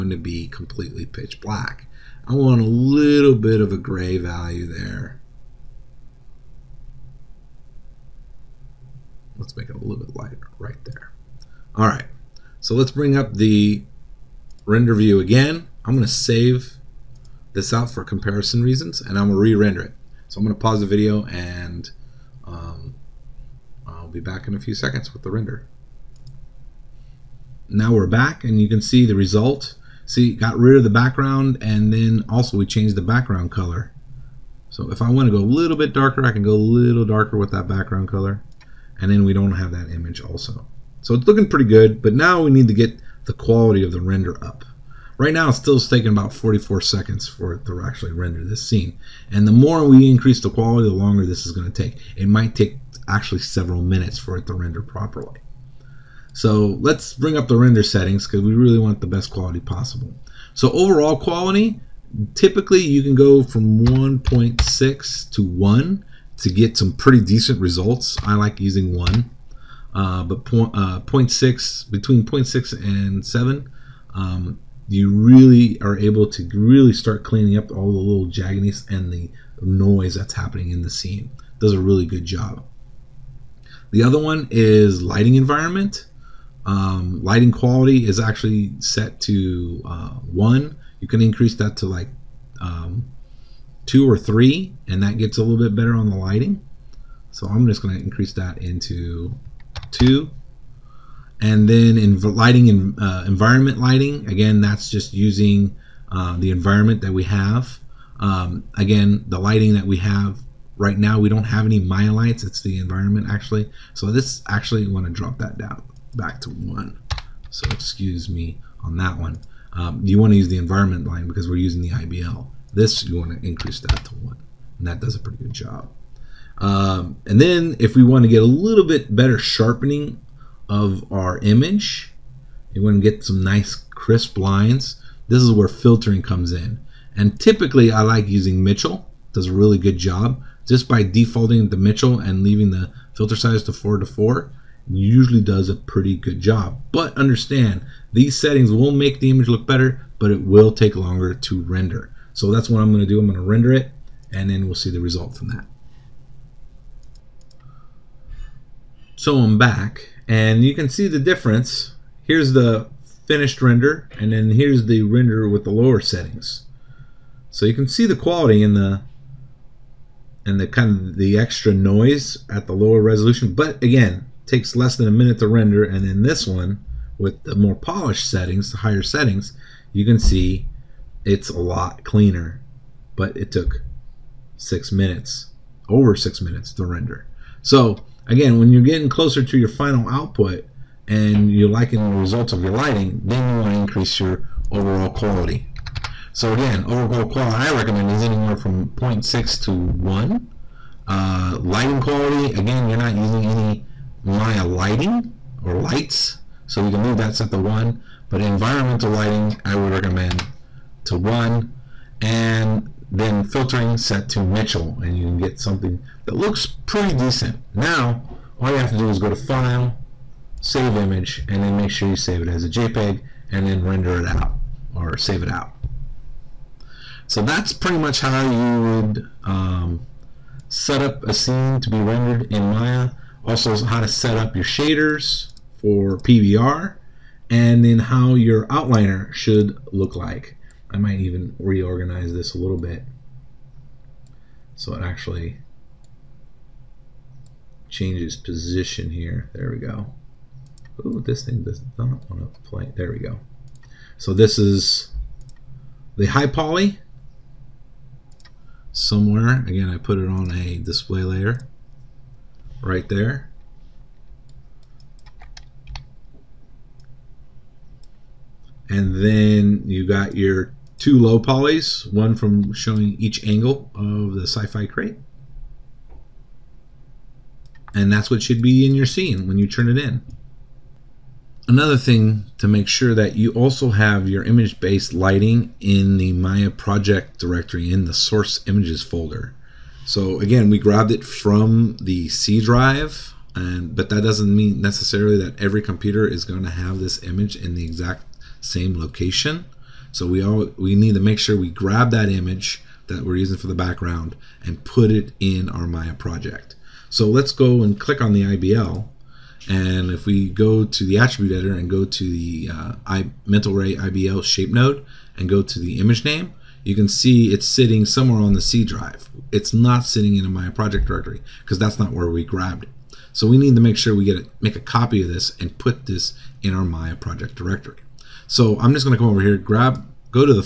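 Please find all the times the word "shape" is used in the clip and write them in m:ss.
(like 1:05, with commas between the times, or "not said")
5:14.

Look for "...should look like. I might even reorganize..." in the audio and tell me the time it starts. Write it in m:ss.
3:59.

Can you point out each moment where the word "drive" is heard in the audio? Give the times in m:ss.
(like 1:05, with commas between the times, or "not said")
4:52, 5:18.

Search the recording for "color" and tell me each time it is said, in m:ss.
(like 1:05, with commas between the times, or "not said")
0:33, 0:38.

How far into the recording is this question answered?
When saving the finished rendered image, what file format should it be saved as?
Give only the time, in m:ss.
3:42.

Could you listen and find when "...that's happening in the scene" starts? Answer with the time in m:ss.
1:20.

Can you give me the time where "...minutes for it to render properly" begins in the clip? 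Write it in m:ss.
0:53.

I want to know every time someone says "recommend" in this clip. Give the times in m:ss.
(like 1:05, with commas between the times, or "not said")
3:17, 3:29.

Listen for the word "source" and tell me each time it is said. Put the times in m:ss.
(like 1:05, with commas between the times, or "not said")
4:48.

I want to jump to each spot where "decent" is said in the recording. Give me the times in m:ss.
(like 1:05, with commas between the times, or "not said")
1:07, 3:37.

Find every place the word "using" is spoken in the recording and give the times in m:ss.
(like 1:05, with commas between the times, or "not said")
1:08, 1:45, 2:01, 2:18, 3:23, 5:03.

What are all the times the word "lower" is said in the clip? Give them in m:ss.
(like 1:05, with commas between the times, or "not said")
2:45, 2:52.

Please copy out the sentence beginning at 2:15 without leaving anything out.
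This is where filtering comes in.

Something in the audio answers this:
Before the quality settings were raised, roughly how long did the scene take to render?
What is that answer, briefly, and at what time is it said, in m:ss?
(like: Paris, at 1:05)
44 seconds, at 0:46.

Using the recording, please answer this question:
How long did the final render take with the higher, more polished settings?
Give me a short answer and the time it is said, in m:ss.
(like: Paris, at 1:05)
over 6 minutes, at 3:04.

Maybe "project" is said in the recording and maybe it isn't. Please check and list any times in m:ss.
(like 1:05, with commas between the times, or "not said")
4:46, 5:06, 5:20, 5:27.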